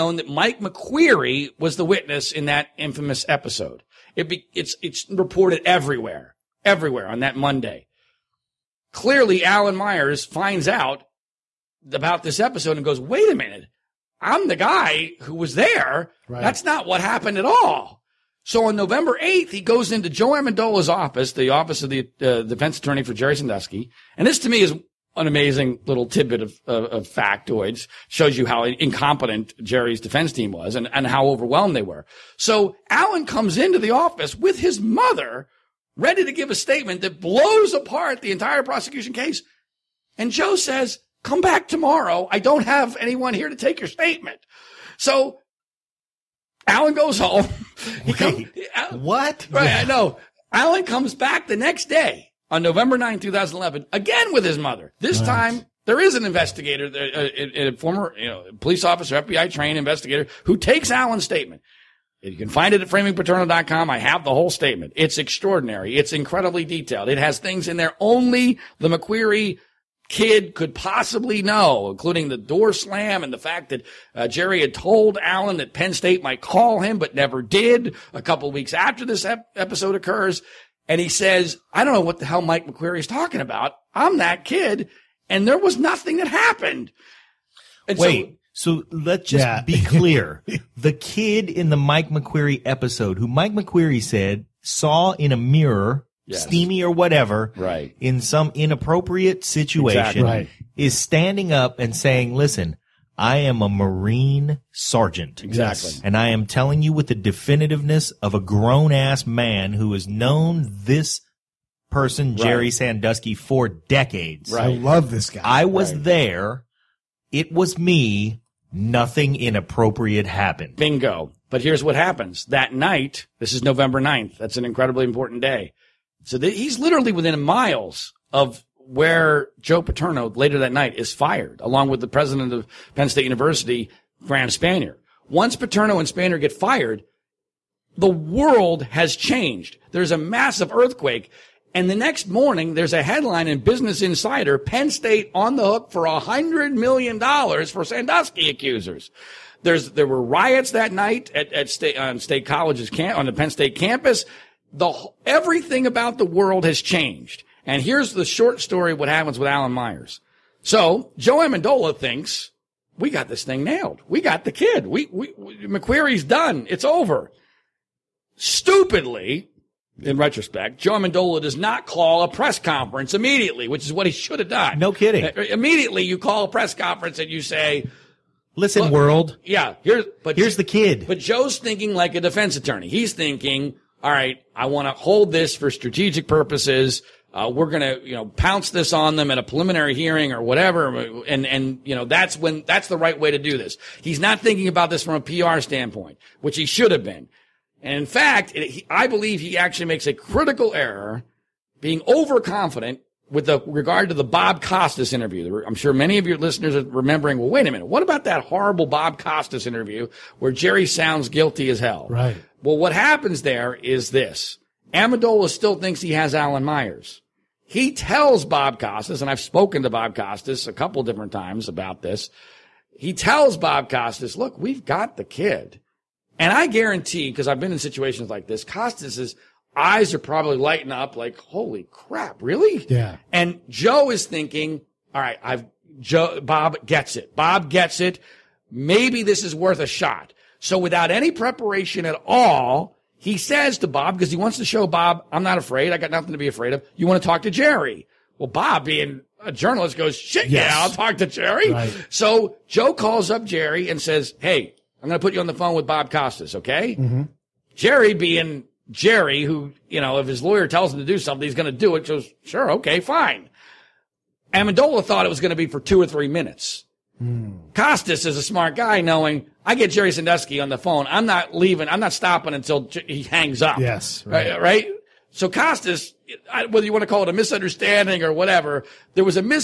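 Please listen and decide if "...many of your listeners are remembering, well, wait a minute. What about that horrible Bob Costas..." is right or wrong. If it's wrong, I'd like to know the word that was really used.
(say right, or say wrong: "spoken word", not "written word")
right.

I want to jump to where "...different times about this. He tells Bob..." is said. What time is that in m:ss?
3:41.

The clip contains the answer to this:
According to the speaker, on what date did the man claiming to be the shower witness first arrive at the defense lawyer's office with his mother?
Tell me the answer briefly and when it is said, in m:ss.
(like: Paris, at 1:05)
November 8, at 0:18.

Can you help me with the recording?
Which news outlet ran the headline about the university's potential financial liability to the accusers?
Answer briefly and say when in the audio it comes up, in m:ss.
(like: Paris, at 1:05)
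Business Insider, at 2:23.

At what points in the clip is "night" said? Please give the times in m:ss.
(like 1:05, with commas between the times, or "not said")
2:02, 2:10, 2:30.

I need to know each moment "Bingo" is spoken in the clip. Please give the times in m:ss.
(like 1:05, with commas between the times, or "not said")
2:00.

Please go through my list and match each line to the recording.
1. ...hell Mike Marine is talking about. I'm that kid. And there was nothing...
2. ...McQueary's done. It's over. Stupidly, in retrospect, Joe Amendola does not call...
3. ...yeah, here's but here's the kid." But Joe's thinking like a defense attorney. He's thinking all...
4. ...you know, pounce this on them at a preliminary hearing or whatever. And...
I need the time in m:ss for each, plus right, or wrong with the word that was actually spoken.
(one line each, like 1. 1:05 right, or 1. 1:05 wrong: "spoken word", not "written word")
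1. 1:22 wrong: "McQueary", not "Marine"
2. 2:45 right
3. 2:59 right
4. 3:08 right.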